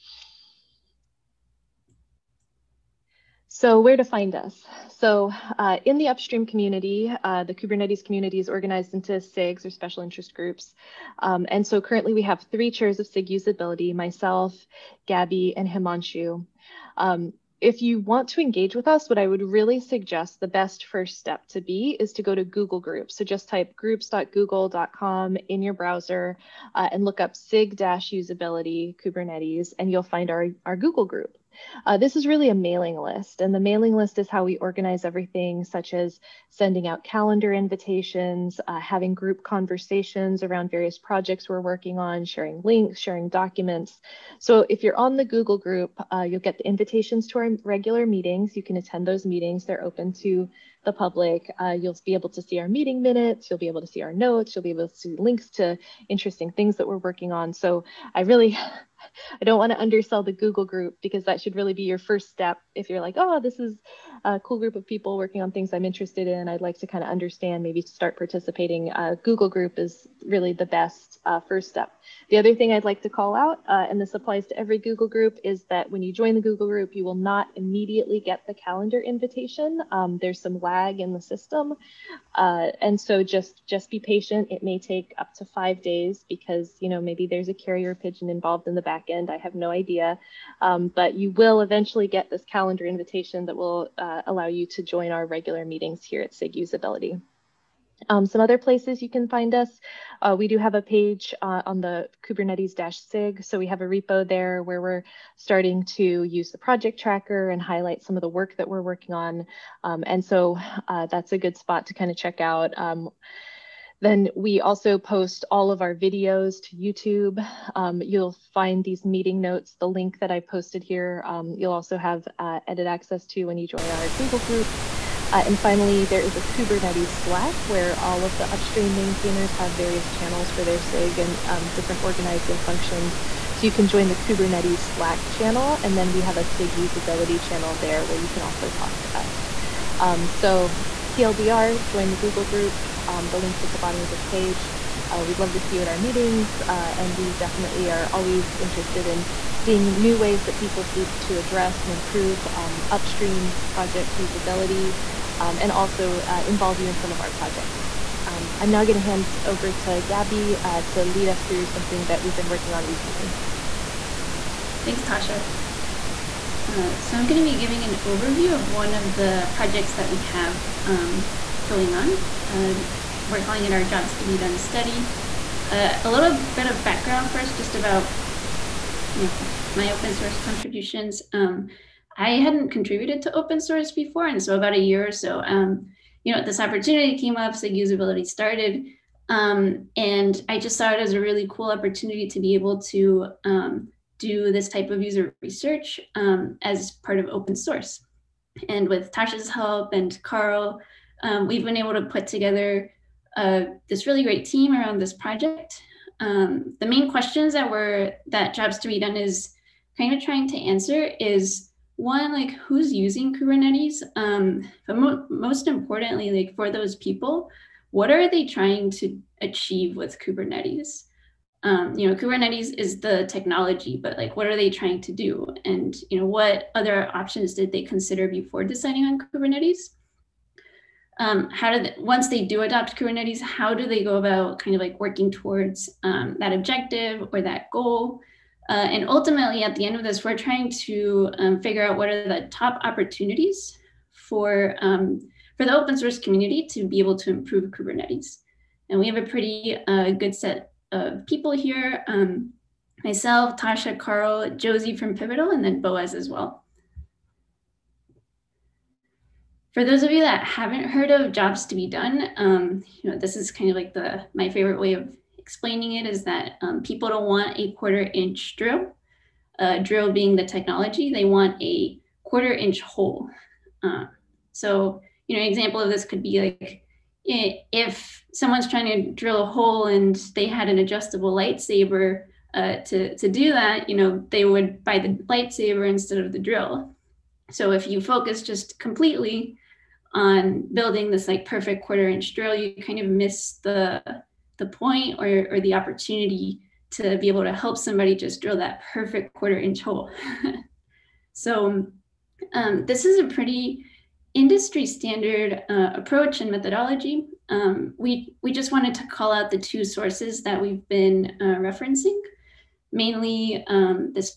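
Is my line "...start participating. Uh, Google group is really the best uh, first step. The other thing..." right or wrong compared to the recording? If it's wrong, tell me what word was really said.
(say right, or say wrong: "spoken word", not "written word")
right.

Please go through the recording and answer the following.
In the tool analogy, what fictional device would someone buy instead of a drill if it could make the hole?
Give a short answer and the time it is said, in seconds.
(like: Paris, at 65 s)
adjustable lightsaber, at 280 s.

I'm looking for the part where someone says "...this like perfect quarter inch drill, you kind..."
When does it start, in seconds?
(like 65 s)
291 s.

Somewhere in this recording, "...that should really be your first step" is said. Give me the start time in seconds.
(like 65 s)
61 s.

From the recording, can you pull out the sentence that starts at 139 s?
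Um, so TLDR, join the Google group.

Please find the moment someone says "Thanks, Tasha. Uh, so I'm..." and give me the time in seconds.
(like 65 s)
164 s.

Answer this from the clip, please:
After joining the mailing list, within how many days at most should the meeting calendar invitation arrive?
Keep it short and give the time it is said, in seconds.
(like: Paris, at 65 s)
5, at 85 s.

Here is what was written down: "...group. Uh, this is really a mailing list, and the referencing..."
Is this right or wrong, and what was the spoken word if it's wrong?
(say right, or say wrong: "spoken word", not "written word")
wrong: "mailing", not "referencing".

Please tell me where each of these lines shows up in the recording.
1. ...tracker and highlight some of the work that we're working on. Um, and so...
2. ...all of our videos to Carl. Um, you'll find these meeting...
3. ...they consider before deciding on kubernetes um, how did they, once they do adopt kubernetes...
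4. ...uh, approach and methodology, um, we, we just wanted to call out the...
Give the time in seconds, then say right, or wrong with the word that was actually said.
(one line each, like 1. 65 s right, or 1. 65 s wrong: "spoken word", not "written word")
1. 106 s right
2. 115 s wrong: "YouTube", not "Carl"
3. 227 s right
4. 305 s right.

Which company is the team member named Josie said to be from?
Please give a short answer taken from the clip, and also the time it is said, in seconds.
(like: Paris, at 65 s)
Pivotal, at 255 s.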